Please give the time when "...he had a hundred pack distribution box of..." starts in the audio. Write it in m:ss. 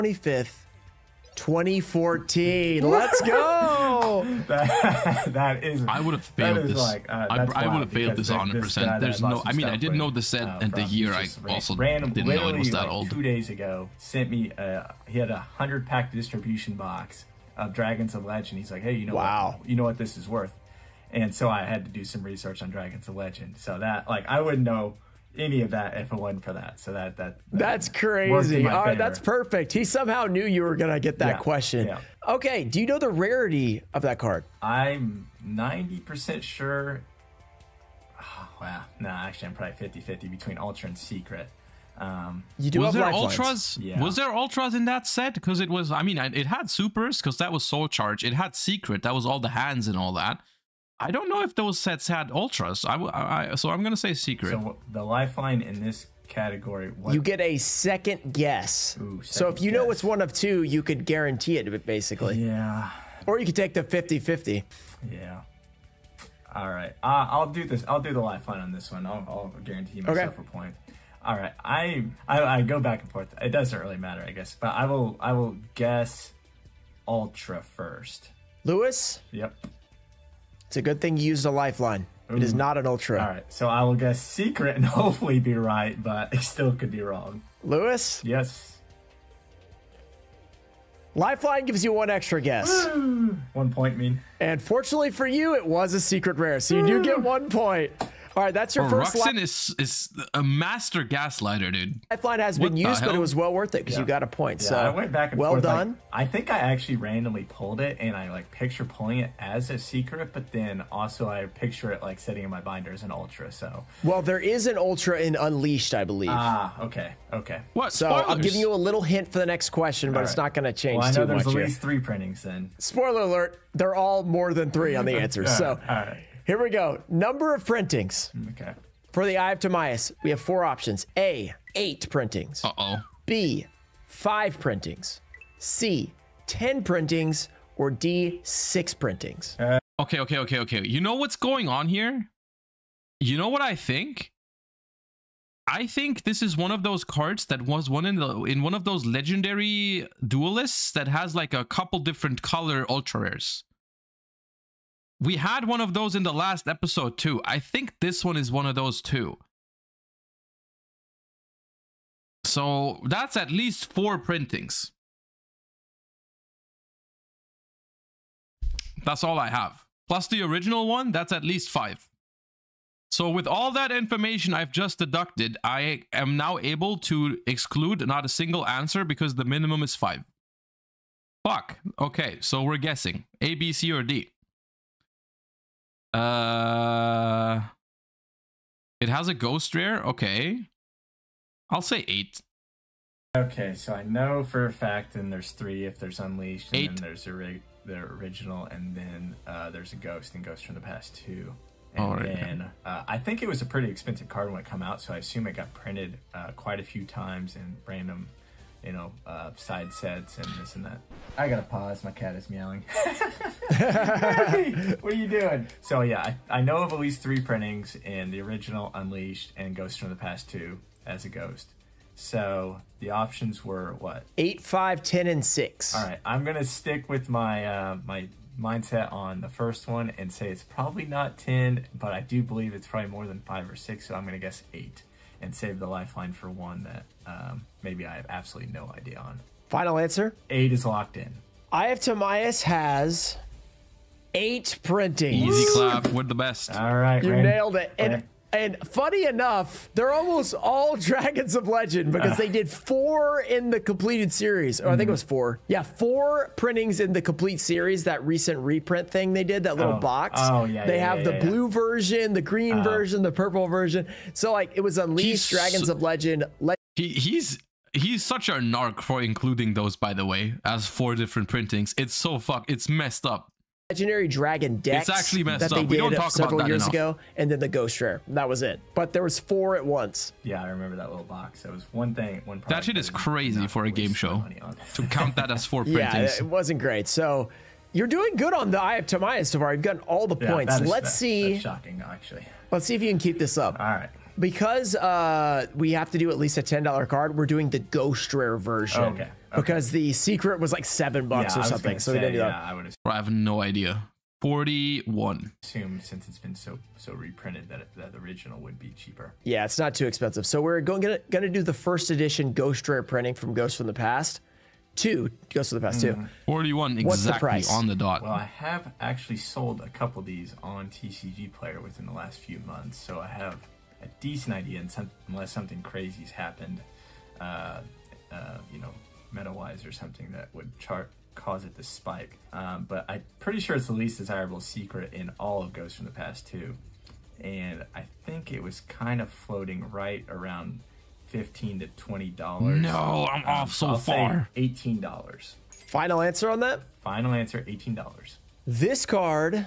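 0:15.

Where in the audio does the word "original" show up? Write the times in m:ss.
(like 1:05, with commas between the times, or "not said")
2:50, 3:17, 3:38, 5:08.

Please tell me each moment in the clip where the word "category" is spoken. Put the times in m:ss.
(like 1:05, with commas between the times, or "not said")
0:56.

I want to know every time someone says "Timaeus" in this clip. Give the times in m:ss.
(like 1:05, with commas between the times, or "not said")
2:09, 4:02, 4:49.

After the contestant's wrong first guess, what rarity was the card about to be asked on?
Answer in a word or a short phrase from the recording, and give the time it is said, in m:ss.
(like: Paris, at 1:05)
Secret rare, at 1:36.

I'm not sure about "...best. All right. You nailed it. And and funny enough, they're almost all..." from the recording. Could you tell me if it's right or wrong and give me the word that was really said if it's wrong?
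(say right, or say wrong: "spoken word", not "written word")
right.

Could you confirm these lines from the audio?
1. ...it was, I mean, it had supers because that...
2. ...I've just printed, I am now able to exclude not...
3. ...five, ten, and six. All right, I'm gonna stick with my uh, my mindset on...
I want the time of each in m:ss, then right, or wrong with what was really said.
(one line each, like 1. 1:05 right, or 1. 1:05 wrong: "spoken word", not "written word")
1. 0:45 right
2. 2:54 wrong: "deducted", not "printed"
3. 3:44 right.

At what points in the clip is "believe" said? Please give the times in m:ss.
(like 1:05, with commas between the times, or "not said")
1:56, 3:52.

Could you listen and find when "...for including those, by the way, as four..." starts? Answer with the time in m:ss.
4:29.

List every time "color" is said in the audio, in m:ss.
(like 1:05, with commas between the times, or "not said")
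2:32.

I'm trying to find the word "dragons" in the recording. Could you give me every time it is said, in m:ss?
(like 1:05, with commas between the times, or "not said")
0:17, 0:22, 4:10, 4:25, 4:34.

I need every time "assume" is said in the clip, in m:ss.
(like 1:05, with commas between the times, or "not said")
3:25, 5:05.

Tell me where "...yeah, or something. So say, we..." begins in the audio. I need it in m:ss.
5:01.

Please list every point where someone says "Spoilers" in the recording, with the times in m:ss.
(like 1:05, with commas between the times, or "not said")
1:58, 2:02.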